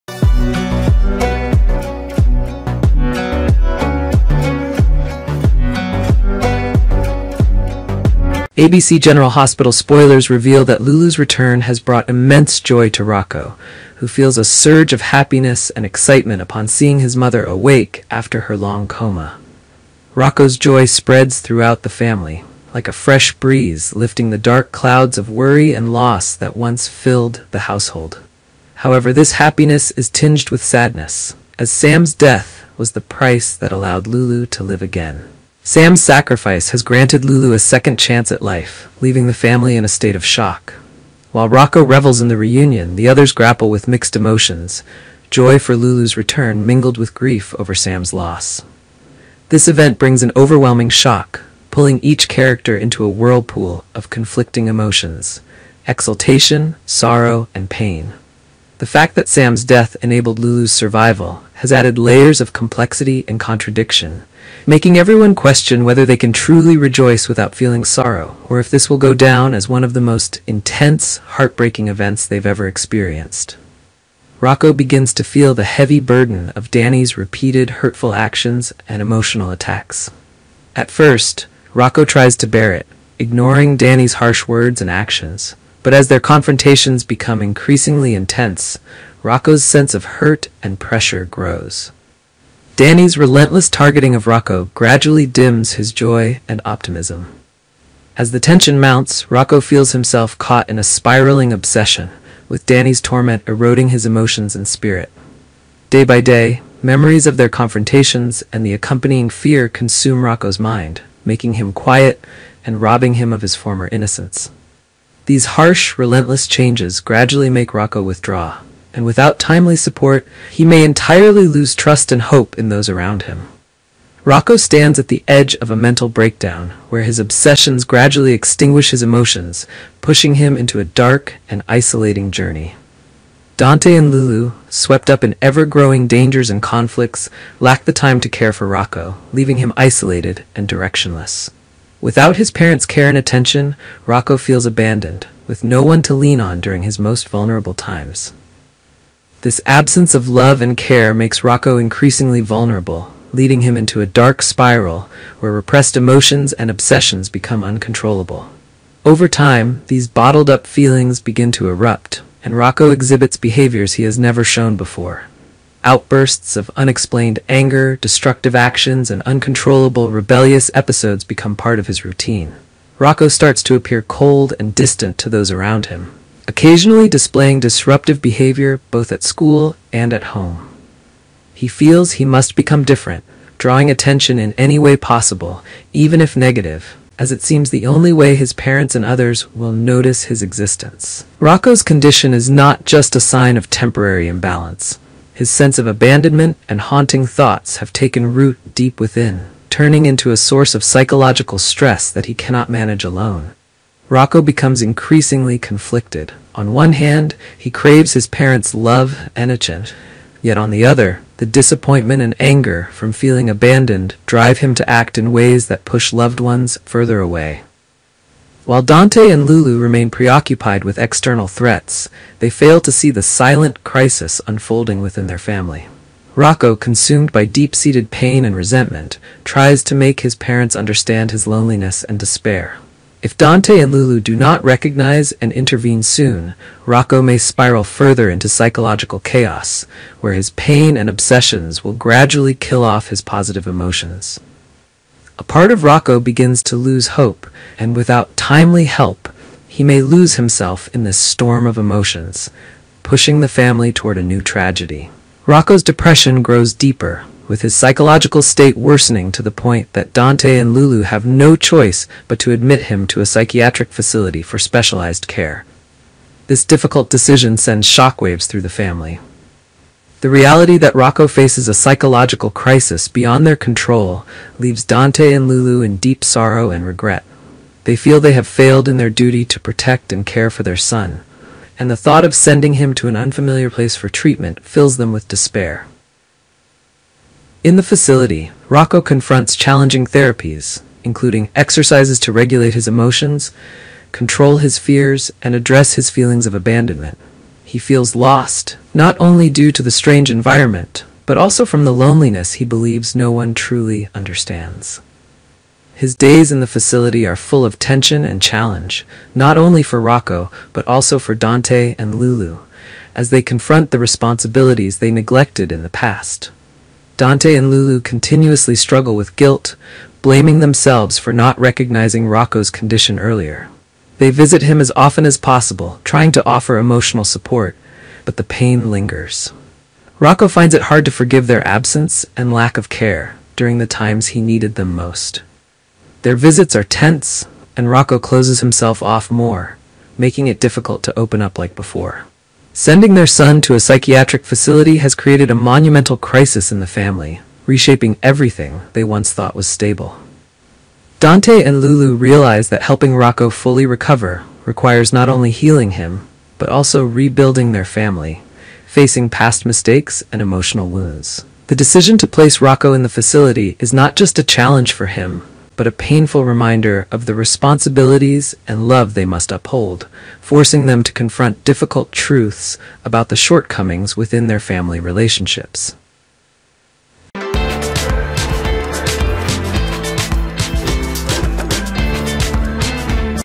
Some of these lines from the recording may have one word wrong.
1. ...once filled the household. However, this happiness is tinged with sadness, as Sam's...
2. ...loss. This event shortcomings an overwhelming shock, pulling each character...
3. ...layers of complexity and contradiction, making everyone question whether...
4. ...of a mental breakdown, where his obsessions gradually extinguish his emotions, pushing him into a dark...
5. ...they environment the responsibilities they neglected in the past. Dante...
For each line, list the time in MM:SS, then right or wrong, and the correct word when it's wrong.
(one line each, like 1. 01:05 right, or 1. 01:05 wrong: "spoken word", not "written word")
1. 00:26 right
2. 00:48 wrong: "brings", not "shortcomings"
3. 01:01 right
4. 02:05 right
5. 05:13 wrong: "confront", not "environment".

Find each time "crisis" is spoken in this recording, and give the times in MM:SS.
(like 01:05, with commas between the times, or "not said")
03:43, 04:32, 05:46.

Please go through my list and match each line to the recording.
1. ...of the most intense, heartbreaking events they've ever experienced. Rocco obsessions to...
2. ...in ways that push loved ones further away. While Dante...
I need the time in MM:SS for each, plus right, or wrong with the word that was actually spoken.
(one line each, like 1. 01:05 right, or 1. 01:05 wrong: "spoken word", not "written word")
1. 01:09 wrong: "begins", not "obsessions"
2. 03:35 right.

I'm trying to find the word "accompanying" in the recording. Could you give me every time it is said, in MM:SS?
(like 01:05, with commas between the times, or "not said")
01:48.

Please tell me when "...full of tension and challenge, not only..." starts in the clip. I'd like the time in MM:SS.
05:07.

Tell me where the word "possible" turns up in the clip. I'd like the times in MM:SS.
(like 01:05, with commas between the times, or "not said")
03:04, 05:25.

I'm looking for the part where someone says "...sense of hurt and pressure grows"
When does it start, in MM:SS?
01:29.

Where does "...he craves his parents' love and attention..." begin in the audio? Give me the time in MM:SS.
03:27.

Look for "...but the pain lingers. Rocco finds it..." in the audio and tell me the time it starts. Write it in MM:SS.
05:28.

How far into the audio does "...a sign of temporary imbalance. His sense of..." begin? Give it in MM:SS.
03:13.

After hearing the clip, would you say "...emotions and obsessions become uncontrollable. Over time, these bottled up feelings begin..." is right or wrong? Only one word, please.
right.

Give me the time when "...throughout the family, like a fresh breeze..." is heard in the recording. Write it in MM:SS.
00:21.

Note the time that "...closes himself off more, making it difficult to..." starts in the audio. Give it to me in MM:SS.
05:38.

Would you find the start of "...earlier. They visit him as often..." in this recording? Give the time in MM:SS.
05:23.